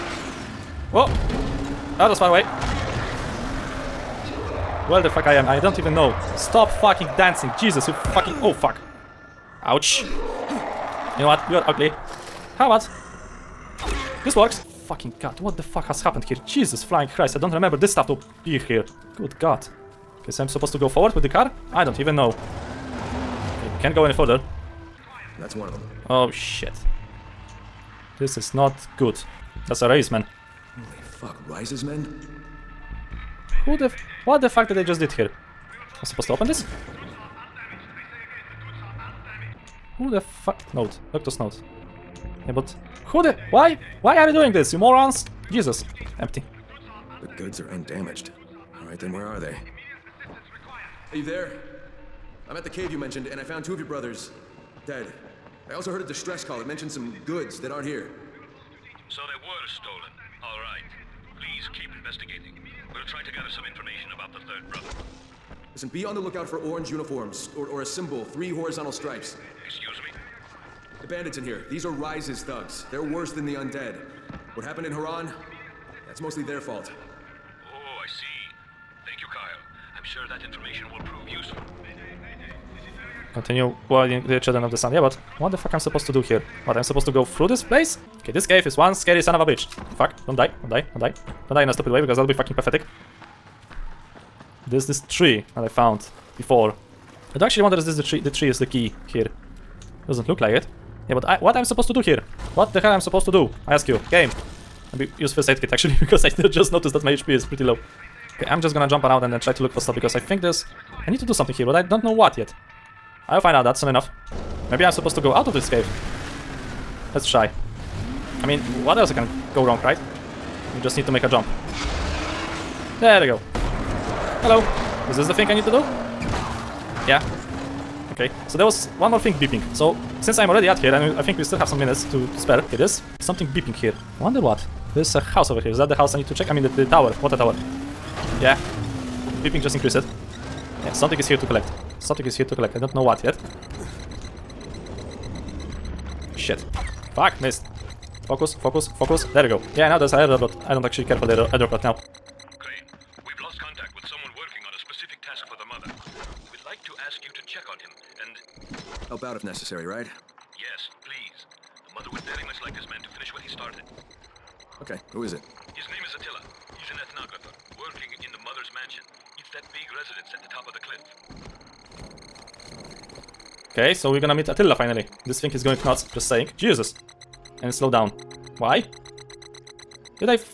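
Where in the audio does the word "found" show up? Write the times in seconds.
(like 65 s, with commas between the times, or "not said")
53 s, 95 s.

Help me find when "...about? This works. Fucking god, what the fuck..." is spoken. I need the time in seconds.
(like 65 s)
12 s.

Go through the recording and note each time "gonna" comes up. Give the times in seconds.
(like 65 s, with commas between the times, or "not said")
108 s, 174 s.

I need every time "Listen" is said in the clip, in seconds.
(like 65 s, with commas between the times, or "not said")
65 s.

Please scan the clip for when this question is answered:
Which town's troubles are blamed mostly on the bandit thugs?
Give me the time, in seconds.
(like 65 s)
74 s.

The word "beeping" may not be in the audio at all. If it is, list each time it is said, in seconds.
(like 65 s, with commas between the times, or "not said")
129 s, 133 s, 139 s.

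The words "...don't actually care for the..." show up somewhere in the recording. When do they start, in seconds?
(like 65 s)
150 s.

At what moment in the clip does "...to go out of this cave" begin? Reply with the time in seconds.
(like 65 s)
115 s.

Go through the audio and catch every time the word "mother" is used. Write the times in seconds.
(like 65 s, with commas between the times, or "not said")
155 s, 161 s, 168 s.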